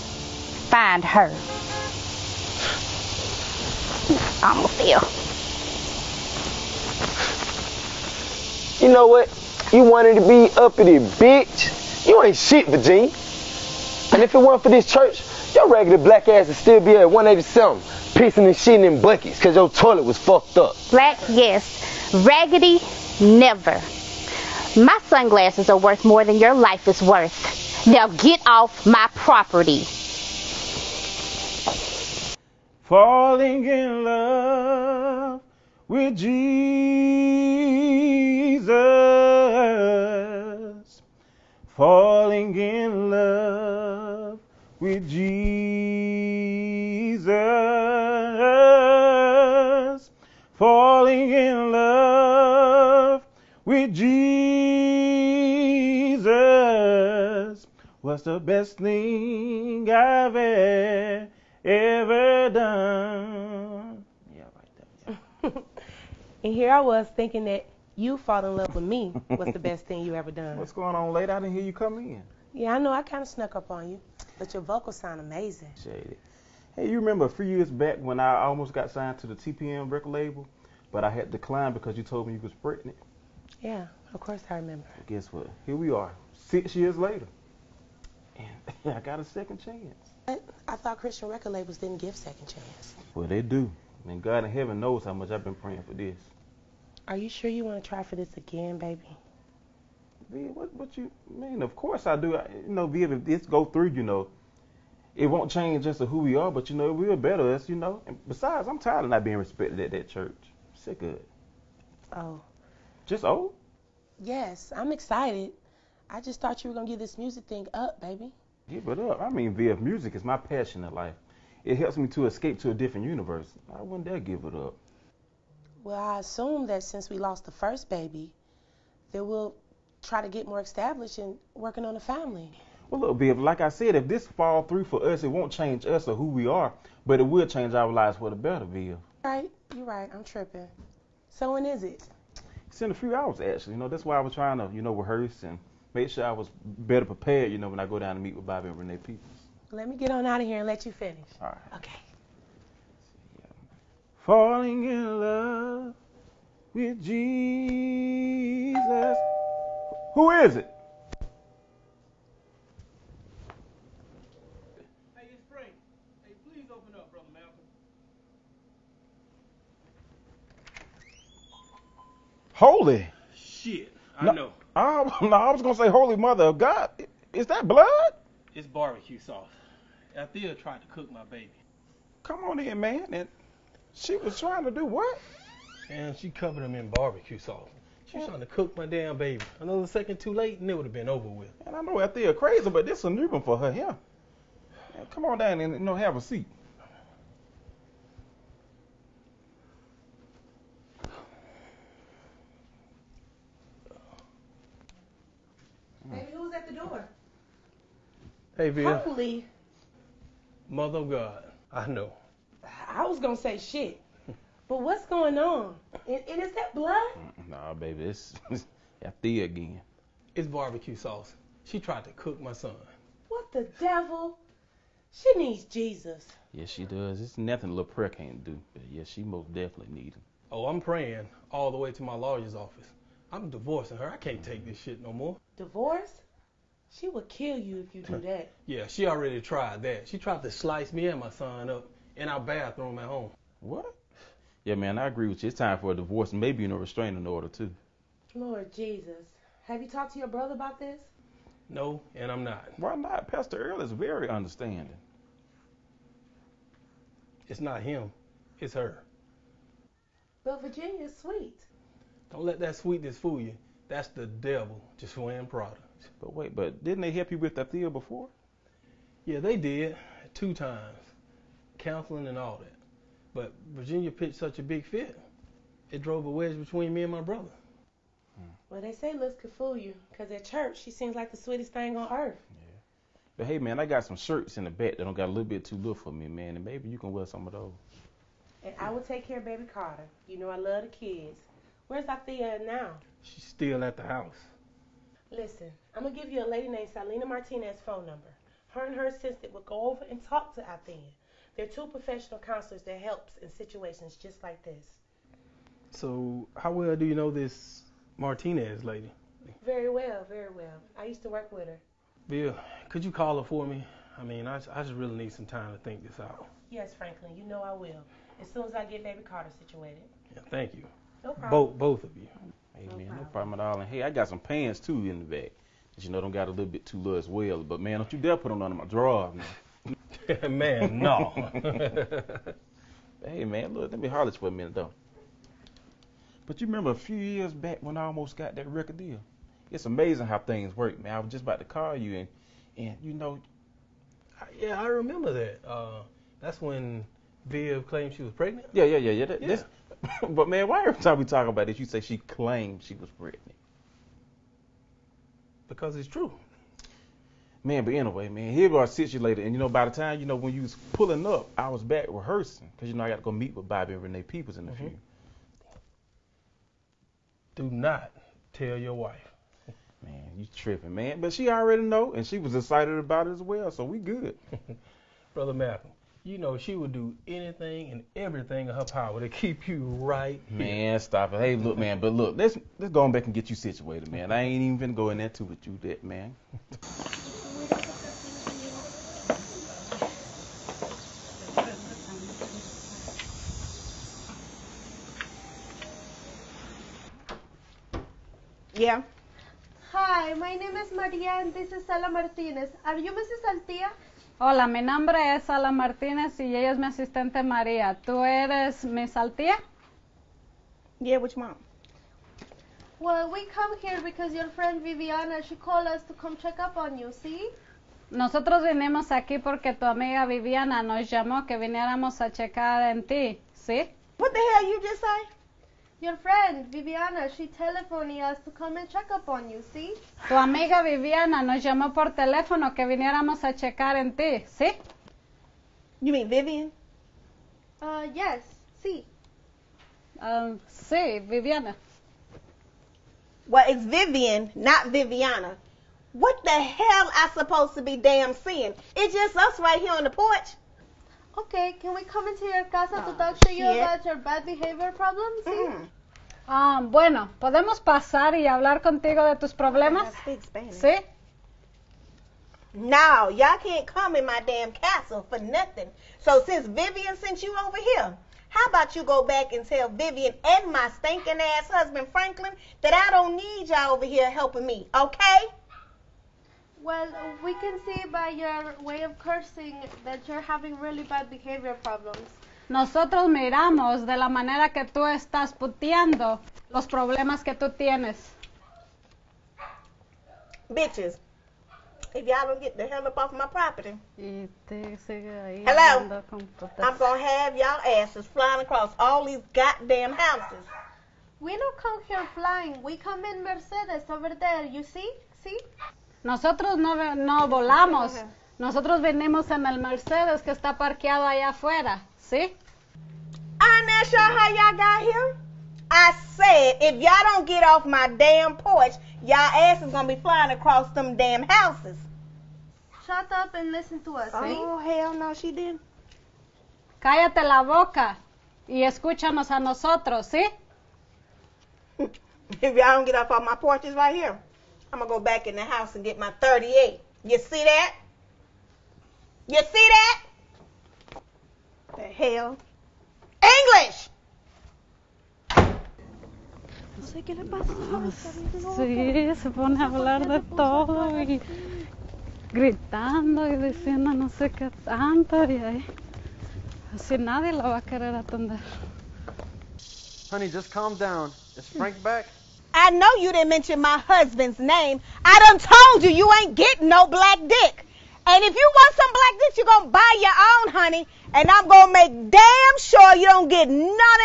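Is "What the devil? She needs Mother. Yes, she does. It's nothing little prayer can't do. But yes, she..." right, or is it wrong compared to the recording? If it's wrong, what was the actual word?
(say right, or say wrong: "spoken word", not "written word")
wrong: "Jesus", not "Mother".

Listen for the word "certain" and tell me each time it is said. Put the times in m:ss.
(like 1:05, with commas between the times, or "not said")
not said.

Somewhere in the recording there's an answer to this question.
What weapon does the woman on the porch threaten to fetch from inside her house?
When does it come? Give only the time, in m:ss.
8:56.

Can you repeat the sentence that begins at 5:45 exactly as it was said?
Uh, that's when Viv claimed she was pregnant.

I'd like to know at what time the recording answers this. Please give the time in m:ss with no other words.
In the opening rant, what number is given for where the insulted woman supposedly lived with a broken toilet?
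0:17.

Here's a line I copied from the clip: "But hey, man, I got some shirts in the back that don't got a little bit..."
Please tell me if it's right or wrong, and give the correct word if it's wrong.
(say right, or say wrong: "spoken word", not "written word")
right.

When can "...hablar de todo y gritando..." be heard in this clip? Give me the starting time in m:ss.
9:09.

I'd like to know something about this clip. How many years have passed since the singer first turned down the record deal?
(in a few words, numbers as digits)
6.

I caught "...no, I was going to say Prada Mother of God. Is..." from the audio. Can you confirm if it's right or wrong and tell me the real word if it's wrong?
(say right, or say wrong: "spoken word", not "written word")
wrong: "Holy", not "Prada".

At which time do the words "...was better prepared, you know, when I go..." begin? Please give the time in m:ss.
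2:26.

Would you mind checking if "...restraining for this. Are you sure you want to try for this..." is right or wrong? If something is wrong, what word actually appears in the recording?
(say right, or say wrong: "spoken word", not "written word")
wrong: "praying", not "restraining".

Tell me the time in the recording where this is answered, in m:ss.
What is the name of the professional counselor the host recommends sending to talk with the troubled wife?
4:56.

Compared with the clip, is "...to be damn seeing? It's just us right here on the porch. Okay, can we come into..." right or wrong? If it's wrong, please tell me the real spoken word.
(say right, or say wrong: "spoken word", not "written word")
right.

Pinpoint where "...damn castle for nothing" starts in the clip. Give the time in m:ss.
7:44.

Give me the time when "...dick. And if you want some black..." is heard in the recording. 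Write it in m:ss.
9:27.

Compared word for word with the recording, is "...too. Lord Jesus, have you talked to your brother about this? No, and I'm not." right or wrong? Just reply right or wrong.
right.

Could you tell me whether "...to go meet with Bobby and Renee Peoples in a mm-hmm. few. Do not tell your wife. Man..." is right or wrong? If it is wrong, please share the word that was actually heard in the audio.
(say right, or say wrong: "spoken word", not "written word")
right.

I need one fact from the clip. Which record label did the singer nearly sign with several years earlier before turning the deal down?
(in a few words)
TPM.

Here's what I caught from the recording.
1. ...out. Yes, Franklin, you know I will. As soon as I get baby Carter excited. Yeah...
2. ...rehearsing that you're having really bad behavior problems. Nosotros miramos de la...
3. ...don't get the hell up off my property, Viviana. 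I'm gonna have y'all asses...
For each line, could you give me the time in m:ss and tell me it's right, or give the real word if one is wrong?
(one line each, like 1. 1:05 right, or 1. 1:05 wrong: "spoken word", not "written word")
1. 5:16 wrong: "situated", not "excited"
2. 7:59 wrong: "cursing", not "rehearsing"
3. 8:12 wrong: "Hello", not "Viviana".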